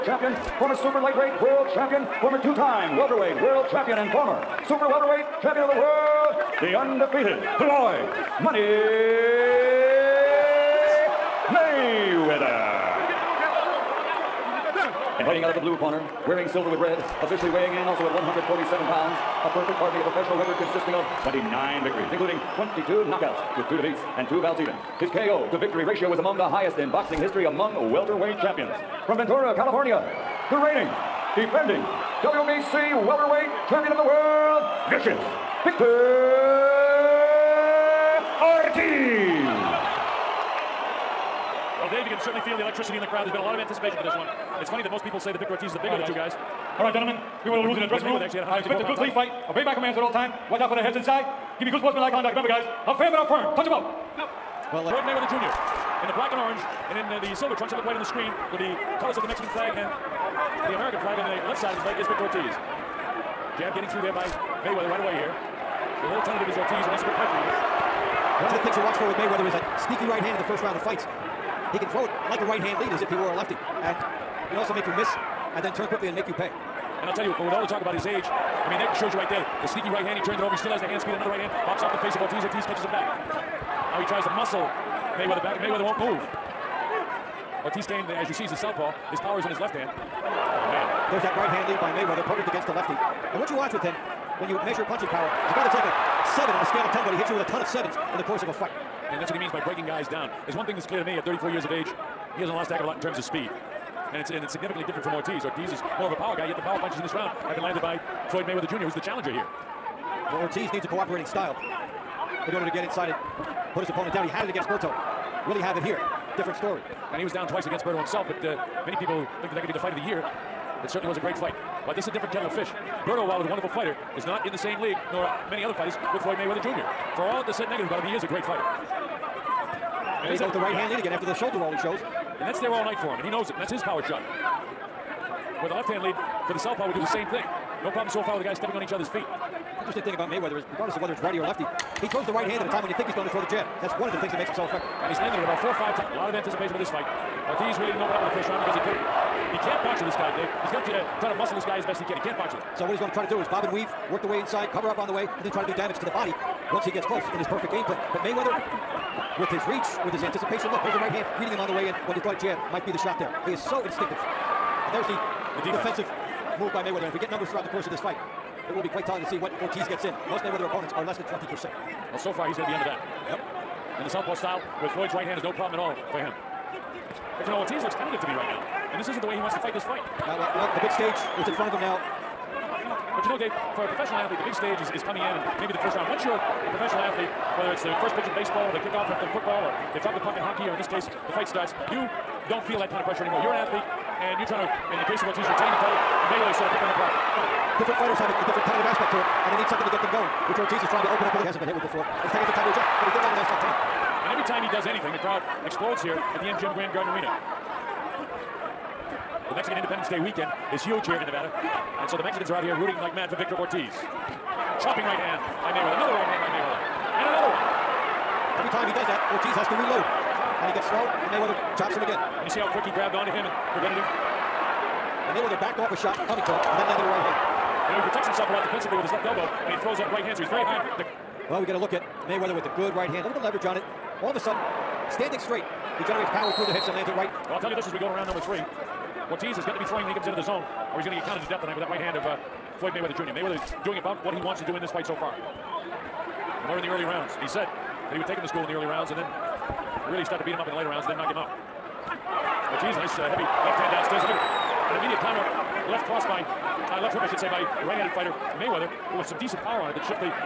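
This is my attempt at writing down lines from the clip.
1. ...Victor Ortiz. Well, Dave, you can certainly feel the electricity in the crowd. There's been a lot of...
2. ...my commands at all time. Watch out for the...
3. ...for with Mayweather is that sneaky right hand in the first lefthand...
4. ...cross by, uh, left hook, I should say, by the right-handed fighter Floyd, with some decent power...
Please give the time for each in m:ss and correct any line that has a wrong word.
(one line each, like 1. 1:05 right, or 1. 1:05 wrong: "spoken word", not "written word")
1. 0:35 right
2. 0:49 right
3. 1:09 wrong: "round", not "lefthand"
4. 4:16 wrong: "Mayweather", not "Floyd".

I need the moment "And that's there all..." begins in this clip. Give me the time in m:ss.
2:12.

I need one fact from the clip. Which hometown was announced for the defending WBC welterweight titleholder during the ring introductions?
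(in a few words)
Ventura, California.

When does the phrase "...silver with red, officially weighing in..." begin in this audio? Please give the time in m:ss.
0:16.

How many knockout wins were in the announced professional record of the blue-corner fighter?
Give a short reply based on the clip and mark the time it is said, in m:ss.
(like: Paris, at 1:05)
22, at 0:22.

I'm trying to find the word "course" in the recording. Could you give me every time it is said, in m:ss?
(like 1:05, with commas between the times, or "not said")
1:38, 2:47.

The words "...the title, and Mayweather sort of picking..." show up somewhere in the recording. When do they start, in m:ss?
3:15.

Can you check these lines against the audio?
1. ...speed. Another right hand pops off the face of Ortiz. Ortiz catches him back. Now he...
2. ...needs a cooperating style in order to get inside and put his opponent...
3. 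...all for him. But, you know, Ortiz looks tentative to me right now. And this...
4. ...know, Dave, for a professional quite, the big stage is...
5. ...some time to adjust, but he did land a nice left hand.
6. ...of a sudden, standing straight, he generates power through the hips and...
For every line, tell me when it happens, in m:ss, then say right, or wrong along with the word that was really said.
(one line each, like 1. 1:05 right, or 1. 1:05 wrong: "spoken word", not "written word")
1. 1:21 right
2. 1:50 right
3. 2:55 right
4. 3:03 wrong: "athlete", not "quite"
5. 3:22 right
6. 3:54 right.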